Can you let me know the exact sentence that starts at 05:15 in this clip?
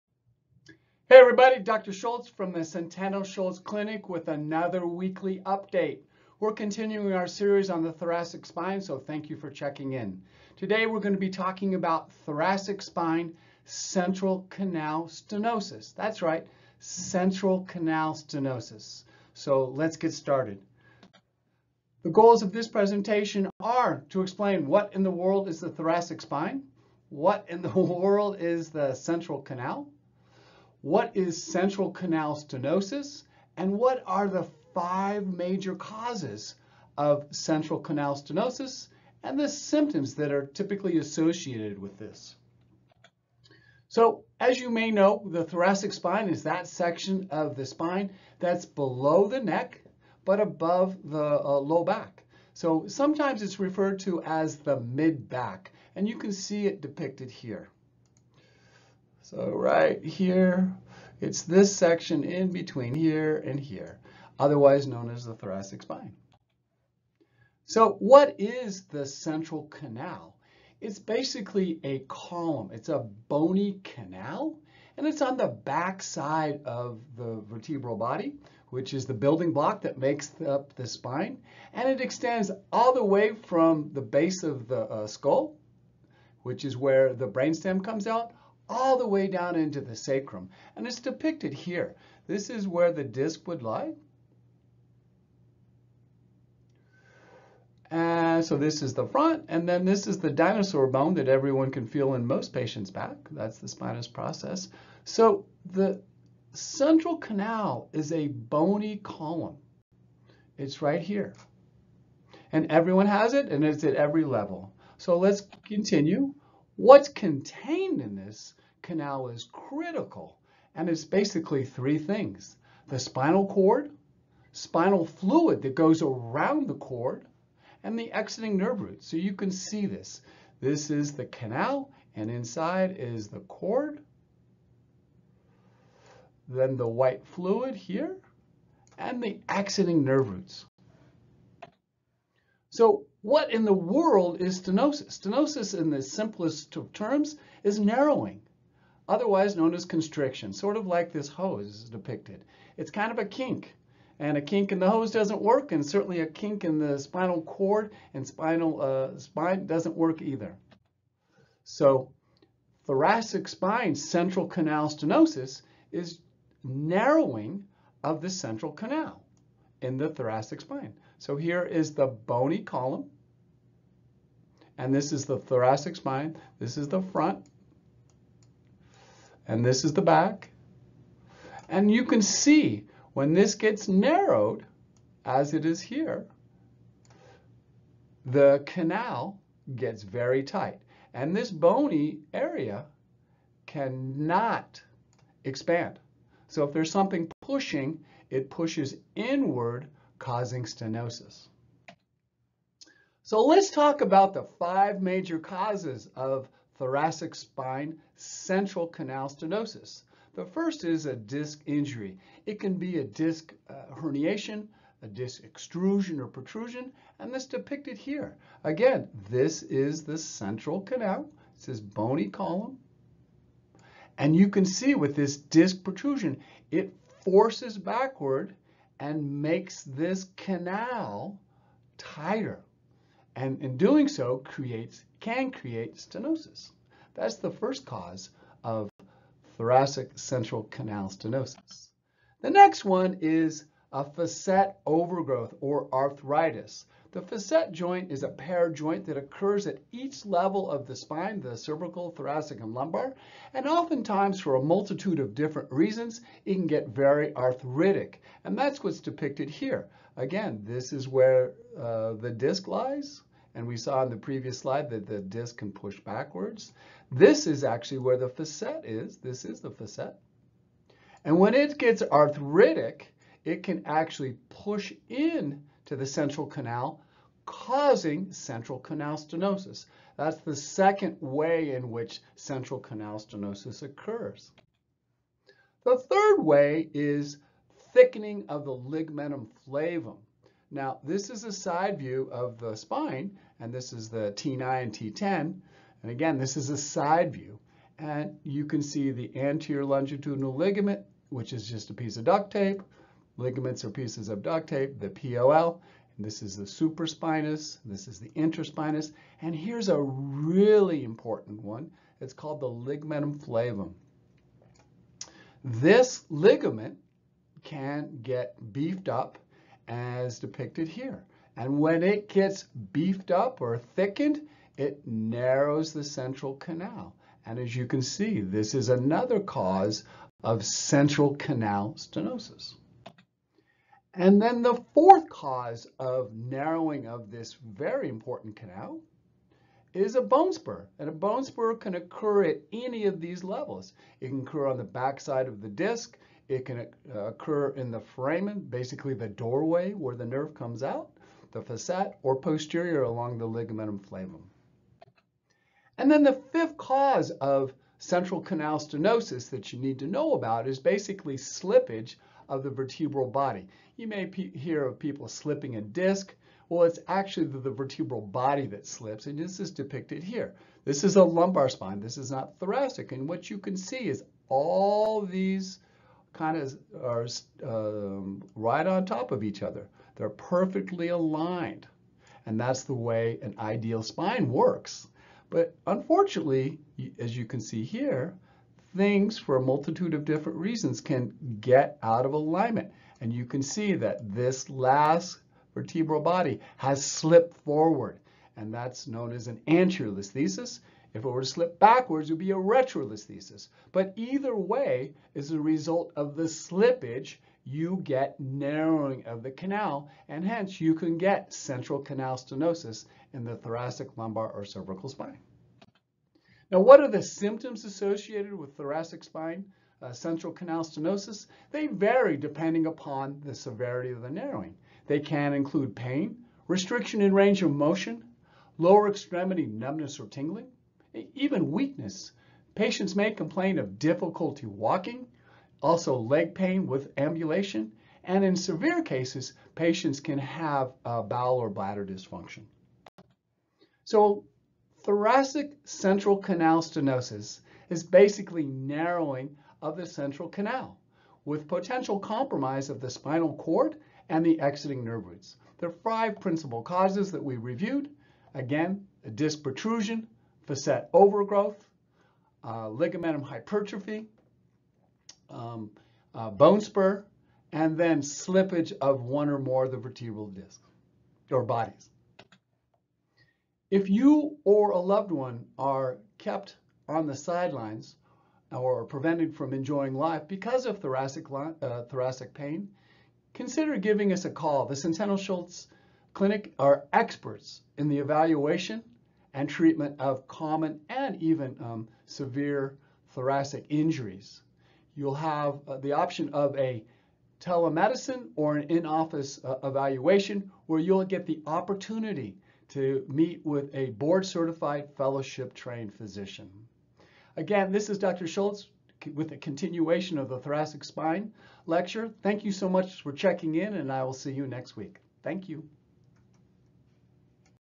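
This ligament can get beefed up as depicted here.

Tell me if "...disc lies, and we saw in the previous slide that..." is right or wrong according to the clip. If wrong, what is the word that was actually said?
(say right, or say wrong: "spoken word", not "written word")
right.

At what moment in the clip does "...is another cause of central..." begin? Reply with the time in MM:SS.
05:28.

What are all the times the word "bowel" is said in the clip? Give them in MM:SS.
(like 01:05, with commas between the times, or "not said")
07:21.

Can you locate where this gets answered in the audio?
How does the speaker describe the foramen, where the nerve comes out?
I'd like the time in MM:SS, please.
05:49.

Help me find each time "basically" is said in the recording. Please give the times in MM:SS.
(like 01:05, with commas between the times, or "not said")
01:10, 02:01, 05:48, 06:00, 07:28.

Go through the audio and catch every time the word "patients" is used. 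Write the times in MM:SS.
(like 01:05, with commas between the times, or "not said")
01:42, 07:12, 07:19.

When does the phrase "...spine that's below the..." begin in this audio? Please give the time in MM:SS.
00:47.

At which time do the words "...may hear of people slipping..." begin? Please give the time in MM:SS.
06:04.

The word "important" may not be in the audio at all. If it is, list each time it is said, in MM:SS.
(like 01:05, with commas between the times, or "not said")
05:11, 05:38.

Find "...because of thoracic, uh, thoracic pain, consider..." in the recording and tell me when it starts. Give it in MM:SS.
08:00.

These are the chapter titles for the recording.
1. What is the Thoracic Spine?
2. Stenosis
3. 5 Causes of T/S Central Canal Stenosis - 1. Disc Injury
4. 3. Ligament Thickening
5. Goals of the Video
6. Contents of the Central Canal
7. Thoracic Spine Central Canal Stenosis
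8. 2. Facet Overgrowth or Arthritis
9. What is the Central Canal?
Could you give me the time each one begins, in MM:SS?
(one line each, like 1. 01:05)
1. 00:43
2. 02:22
3. 03:21
4. 04:45
5. 00:21
6. 01:56
7. 02:41
8. 04:02
9. 01:07.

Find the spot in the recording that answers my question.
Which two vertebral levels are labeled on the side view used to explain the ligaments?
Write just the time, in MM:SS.
04:54.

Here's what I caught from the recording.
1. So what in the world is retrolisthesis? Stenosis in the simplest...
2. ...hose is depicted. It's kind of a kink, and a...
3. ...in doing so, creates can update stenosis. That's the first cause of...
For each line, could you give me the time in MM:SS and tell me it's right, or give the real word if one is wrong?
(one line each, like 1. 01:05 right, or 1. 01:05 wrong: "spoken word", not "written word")
1. 02:22 wrong: "stenosis", not "retrolisthesis"
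2. 02:31 right
3. 03:53 wrong: "create", not "update".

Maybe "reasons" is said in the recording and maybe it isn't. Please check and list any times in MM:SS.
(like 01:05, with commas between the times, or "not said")
04:15, 06:30.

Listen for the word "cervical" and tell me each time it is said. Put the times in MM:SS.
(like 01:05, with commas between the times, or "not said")
04:11, 06:54.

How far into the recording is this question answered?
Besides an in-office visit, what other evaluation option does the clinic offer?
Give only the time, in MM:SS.
08:17.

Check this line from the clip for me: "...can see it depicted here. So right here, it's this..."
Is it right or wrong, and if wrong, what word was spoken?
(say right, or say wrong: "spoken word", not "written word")
right.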